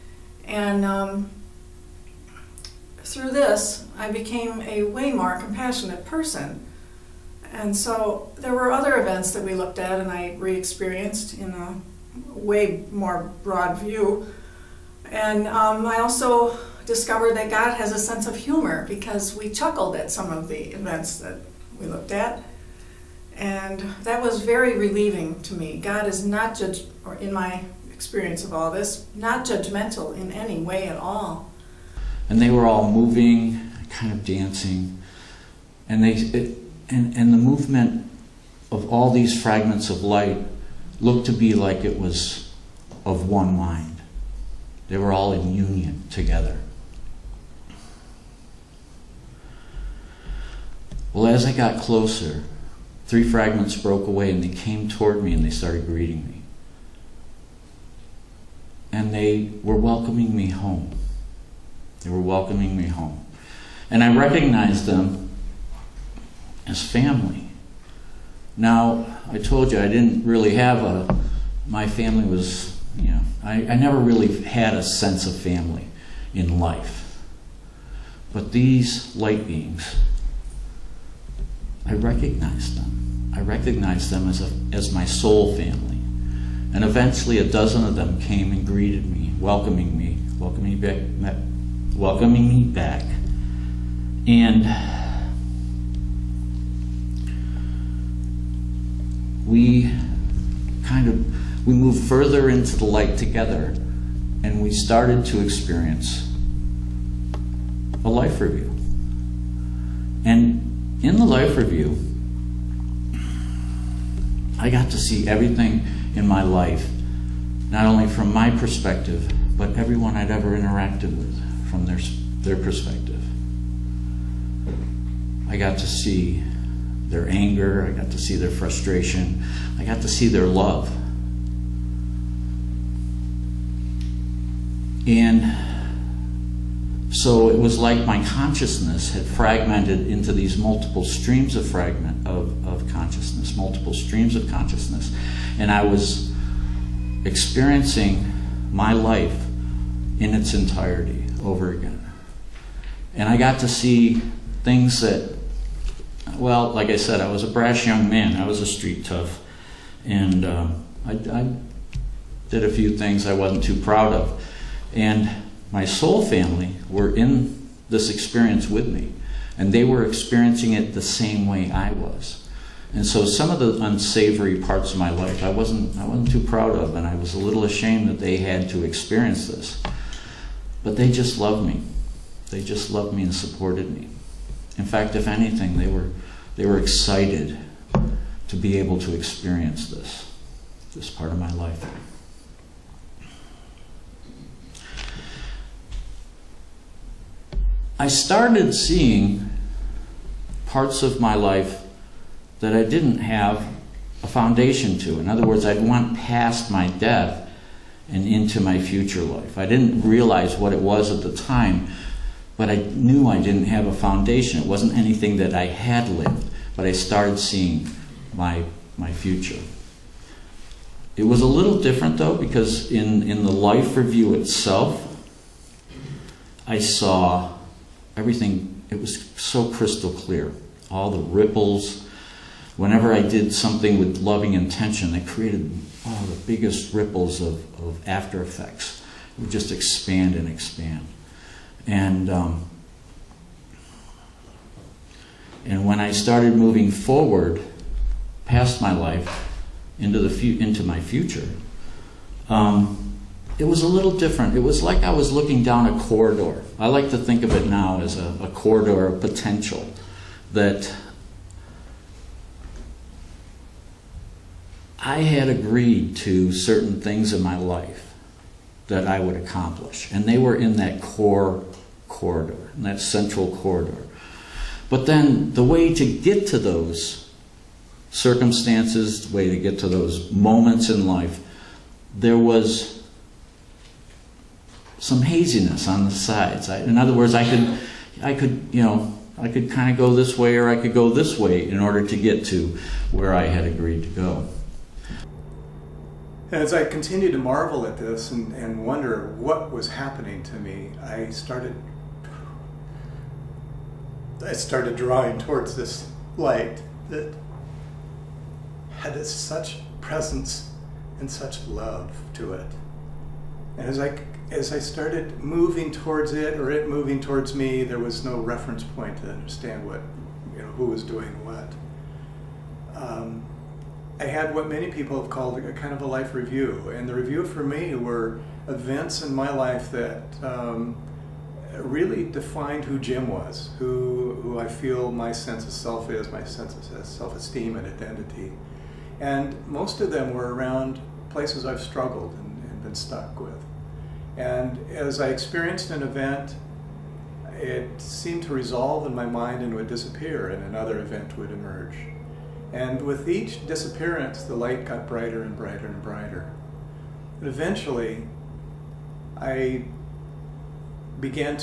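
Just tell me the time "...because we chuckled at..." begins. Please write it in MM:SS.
00:18.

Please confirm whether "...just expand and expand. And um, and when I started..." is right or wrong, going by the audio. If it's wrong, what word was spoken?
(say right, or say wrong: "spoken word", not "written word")
right.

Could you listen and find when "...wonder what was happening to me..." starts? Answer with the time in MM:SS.
04:58.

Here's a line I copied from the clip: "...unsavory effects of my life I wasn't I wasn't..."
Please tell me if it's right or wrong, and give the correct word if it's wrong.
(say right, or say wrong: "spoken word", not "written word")
wrong: "parts", not "effects".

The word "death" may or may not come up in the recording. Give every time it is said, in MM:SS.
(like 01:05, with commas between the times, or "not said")
03:26.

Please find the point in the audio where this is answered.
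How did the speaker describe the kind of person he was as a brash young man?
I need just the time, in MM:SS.
02:38.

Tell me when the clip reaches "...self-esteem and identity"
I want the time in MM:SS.
05:37.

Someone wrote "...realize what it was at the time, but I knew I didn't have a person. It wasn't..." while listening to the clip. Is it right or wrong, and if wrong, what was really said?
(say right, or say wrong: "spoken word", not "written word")
wrong: "foundation", not "person".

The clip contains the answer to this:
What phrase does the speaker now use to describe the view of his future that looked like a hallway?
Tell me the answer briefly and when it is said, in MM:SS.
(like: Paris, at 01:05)
Corridor of potential, at 04:18.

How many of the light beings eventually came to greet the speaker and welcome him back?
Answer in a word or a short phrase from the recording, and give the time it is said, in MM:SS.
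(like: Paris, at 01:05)
A dozen, at 01:27.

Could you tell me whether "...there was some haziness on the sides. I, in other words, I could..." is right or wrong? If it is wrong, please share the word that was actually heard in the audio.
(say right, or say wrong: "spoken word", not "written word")
right.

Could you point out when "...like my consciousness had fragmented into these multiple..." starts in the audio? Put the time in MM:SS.
02:17.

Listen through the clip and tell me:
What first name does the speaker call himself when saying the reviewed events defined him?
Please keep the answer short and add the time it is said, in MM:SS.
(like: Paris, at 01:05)
Jim, at 05:32.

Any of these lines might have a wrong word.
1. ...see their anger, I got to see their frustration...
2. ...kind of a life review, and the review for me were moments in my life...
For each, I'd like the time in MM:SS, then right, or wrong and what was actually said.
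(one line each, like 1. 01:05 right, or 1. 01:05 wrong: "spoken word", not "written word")
1. 02:05 right
2. 05:25 wrong: "events", not "moments".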